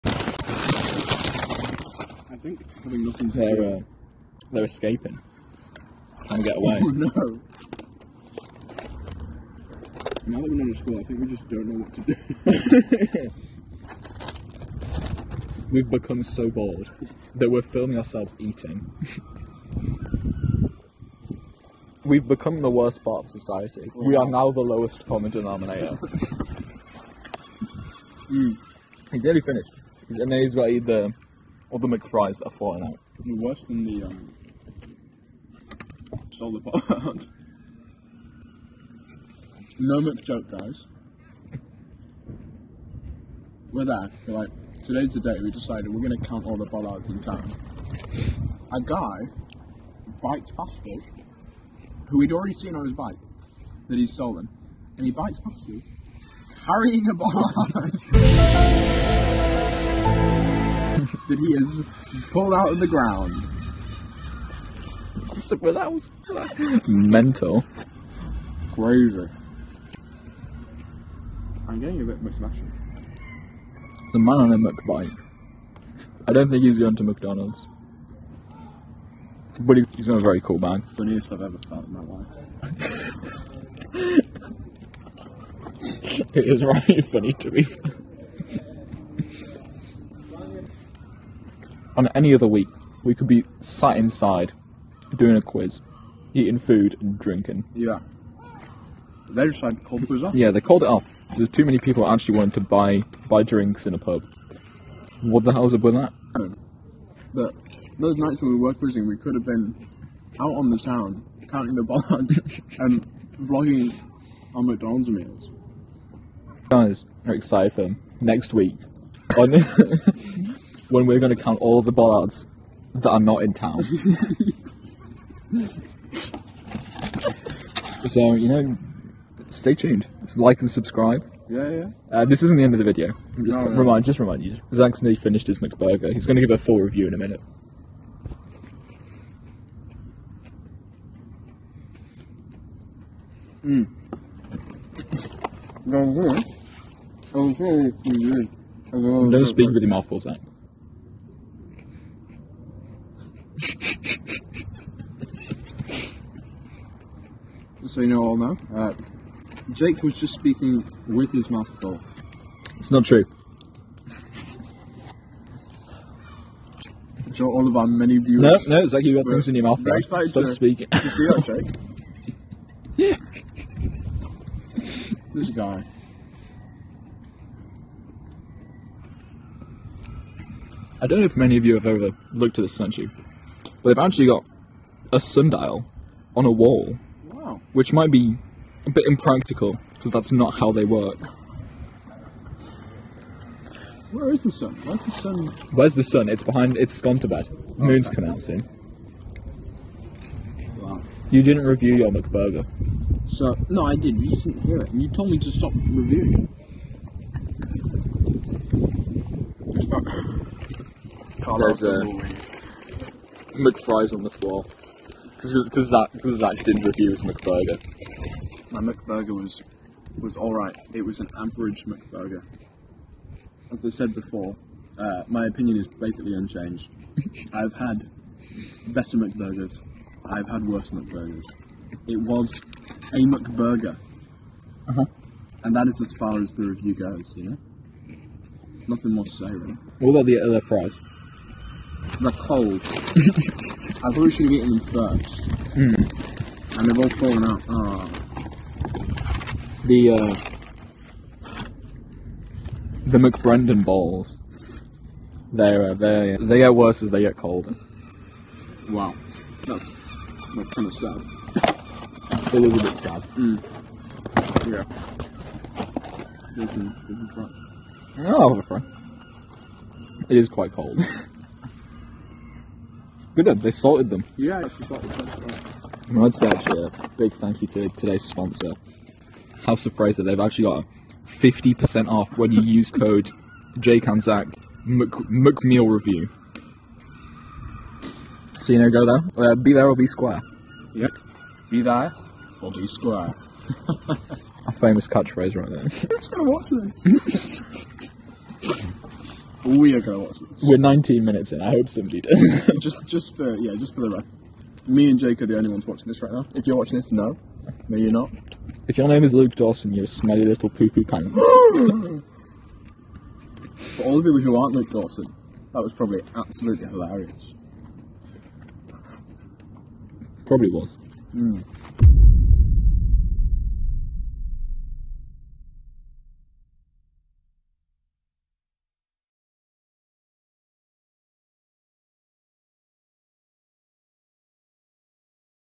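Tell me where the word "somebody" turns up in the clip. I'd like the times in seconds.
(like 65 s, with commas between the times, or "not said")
301 s.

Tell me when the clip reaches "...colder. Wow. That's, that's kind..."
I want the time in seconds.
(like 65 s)
257 s.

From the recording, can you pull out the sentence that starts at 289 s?
Uh, be there or be square.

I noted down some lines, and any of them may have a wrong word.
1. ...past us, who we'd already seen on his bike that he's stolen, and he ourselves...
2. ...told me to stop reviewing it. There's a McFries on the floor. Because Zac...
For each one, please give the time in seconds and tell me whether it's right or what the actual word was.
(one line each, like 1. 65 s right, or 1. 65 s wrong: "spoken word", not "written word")
1. 50 s wrong: "bikes", not "ourselves"
2. 205 s right.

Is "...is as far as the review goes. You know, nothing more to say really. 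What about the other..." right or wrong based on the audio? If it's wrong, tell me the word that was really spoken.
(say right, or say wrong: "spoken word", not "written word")
right.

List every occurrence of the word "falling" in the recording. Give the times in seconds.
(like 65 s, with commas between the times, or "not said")
32 s, 247 s.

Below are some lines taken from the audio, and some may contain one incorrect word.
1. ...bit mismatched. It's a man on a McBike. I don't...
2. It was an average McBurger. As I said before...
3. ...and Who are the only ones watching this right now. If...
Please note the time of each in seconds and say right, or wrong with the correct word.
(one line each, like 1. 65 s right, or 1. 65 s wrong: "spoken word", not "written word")
1. 72 s right
2. 220 s right
3. 305 s wrong: "Jake", not "Who".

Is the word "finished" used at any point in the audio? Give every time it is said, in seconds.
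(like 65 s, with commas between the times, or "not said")
29 s, 135 s.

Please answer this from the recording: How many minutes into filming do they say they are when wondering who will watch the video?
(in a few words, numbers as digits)
19.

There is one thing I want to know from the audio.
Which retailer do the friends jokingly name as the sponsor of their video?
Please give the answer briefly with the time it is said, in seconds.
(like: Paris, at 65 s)
House of Fraser, at 279 s.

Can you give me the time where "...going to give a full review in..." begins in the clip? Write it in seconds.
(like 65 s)
136 s.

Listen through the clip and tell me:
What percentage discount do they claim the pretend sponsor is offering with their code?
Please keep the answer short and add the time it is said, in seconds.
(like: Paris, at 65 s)
50%, at 281 s.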